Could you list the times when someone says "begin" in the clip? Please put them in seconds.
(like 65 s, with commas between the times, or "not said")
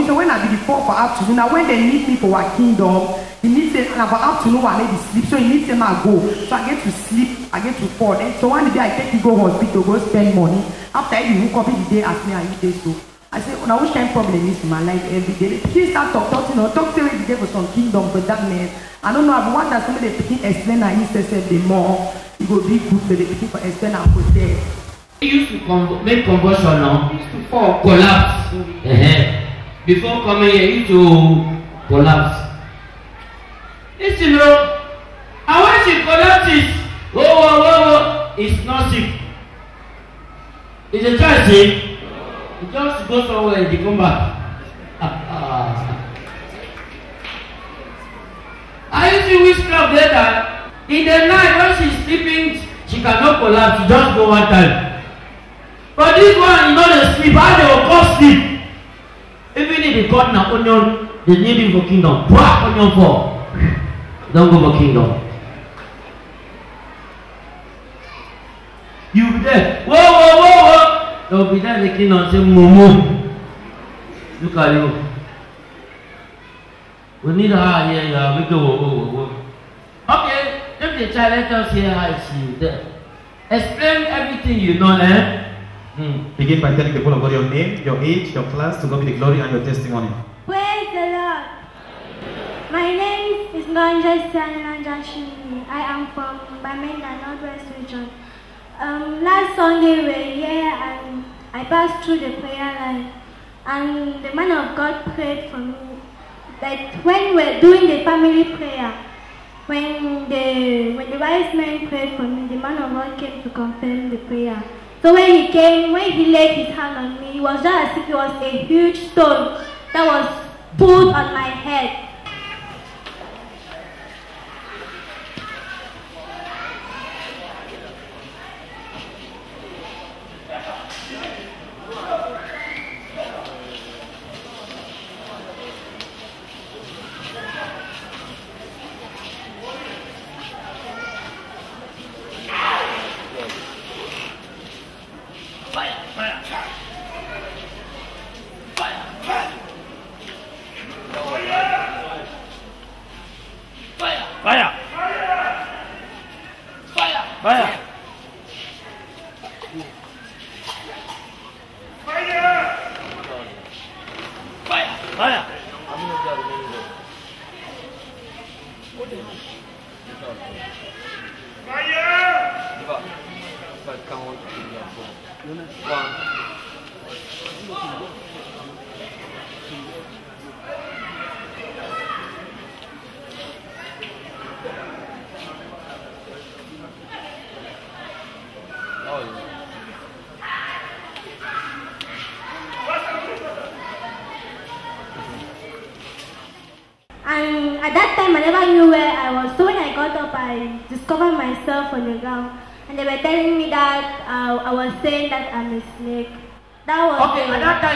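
20 s, 86 s.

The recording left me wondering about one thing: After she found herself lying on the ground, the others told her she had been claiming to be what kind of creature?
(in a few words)
A snake.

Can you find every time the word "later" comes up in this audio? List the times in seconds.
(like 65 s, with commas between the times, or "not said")
49 s.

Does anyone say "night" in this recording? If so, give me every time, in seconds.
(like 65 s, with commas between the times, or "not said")
51 s.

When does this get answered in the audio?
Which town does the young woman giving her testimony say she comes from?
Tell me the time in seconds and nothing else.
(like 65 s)
96 s.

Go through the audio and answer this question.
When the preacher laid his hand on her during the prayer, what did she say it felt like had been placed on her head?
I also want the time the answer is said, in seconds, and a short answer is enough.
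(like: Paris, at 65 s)
A huge stone, at 118 s.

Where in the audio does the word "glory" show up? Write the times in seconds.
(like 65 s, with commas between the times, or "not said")
89 s.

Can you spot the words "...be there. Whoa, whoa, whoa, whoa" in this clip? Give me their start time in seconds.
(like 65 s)
69 s.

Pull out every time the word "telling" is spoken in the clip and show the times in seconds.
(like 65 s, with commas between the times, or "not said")
86 s, 203 s.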